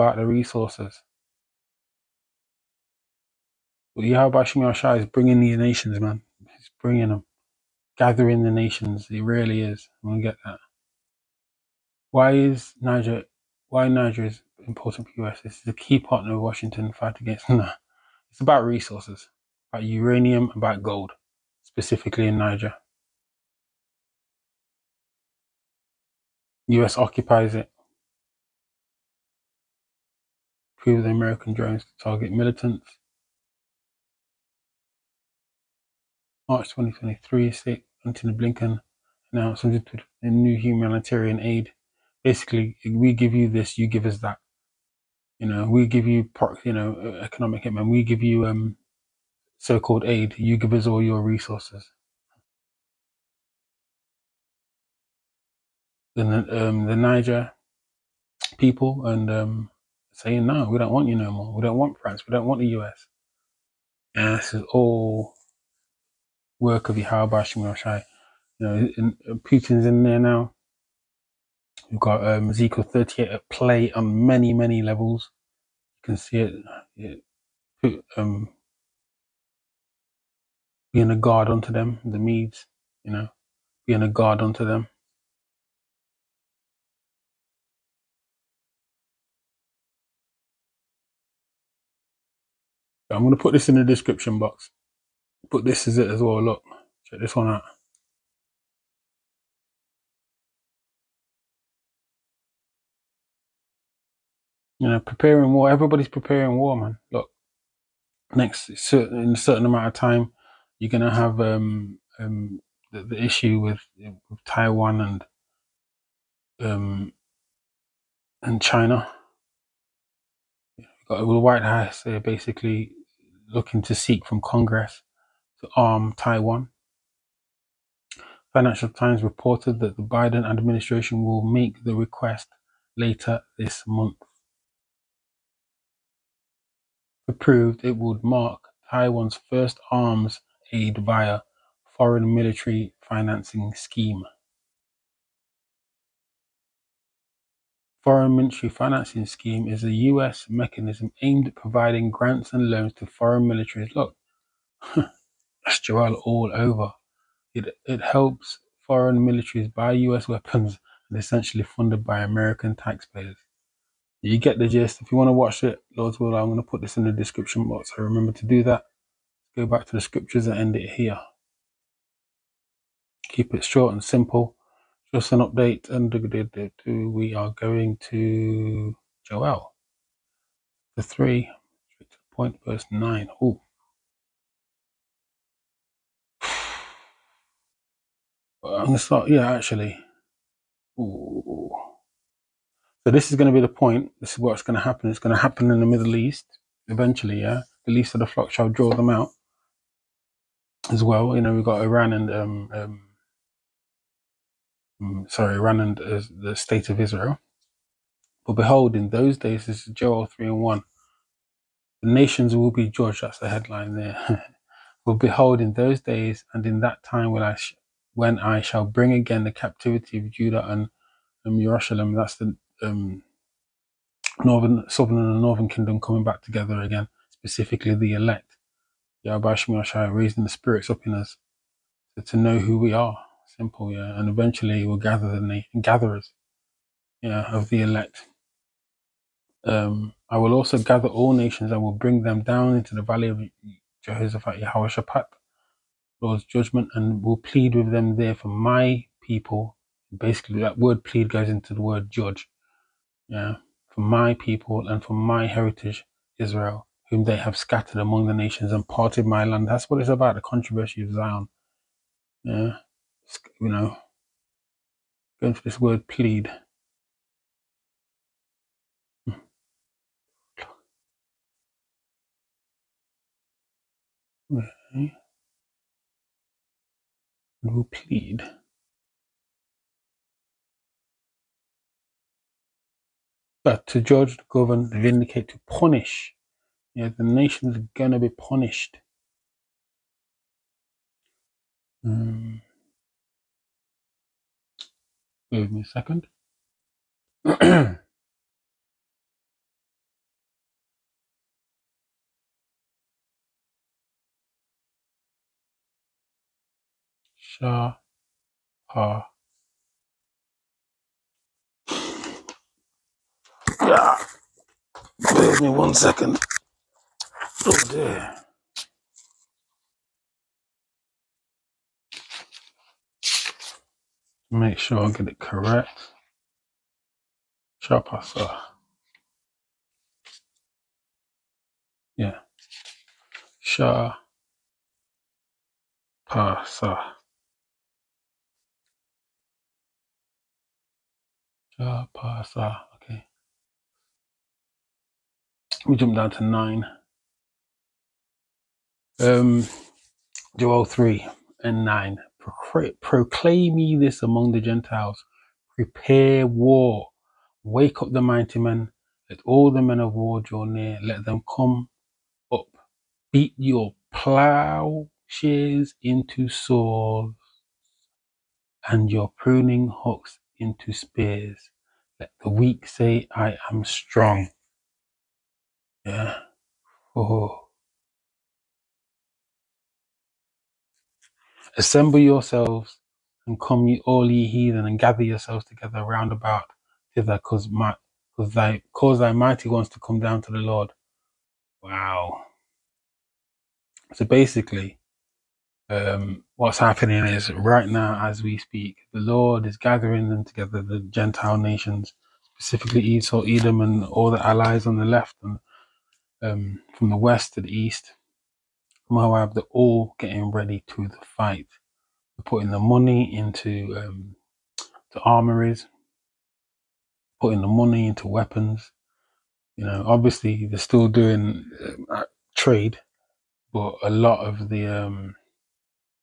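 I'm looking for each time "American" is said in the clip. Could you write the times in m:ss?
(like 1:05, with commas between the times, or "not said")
0:31, 2:42.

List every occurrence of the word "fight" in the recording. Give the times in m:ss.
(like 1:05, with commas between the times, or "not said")
0:16, 6:51.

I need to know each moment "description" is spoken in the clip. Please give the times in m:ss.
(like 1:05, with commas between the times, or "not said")
1:33, 2:47.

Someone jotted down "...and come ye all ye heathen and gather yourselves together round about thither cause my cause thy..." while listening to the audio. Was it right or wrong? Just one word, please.
right.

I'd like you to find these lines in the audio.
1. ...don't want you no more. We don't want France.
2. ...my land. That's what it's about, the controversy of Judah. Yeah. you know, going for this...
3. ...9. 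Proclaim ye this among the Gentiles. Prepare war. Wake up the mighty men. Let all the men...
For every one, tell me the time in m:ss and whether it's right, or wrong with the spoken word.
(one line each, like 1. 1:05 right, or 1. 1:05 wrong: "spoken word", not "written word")
1. 1:00 right
2. 4:19 wrong: "Zion", not "Judah"
3. 5:51 right.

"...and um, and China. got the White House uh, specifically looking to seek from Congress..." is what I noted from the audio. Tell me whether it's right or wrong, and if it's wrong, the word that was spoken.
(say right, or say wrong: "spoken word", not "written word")
wrong: "basically", not "specifically".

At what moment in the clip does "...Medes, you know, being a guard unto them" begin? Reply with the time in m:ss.
1:22.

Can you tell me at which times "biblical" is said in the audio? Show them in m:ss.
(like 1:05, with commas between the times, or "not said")
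not said.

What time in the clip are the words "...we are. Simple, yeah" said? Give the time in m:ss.
3:52.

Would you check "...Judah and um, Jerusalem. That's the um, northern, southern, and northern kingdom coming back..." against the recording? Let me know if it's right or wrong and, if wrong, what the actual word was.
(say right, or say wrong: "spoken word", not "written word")
right.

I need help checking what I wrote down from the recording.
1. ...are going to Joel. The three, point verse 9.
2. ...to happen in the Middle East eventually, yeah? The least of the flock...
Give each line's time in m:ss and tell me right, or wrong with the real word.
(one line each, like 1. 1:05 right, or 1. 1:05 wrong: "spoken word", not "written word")
1. 2:57 right
2. 3:15 right.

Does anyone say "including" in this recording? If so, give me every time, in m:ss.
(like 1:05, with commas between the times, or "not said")
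not said.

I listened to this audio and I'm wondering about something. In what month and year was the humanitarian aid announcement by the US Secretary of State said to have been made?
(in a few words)
March 2023.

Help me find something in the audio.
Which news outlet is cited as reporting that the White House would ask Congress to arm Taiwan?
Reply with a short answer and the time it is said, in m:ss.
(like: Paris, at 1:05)
Financial Times, at 2:08.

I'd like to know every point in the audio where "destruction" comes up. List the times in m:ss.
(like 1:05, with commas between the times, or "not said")
not said.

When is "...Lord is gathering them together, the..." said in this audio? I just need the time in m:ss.
6:39.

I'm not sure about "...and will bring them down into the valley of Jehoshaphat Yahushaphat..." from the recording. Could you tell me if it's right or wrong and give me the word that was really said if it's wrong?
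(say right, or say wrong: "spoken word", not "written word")
right.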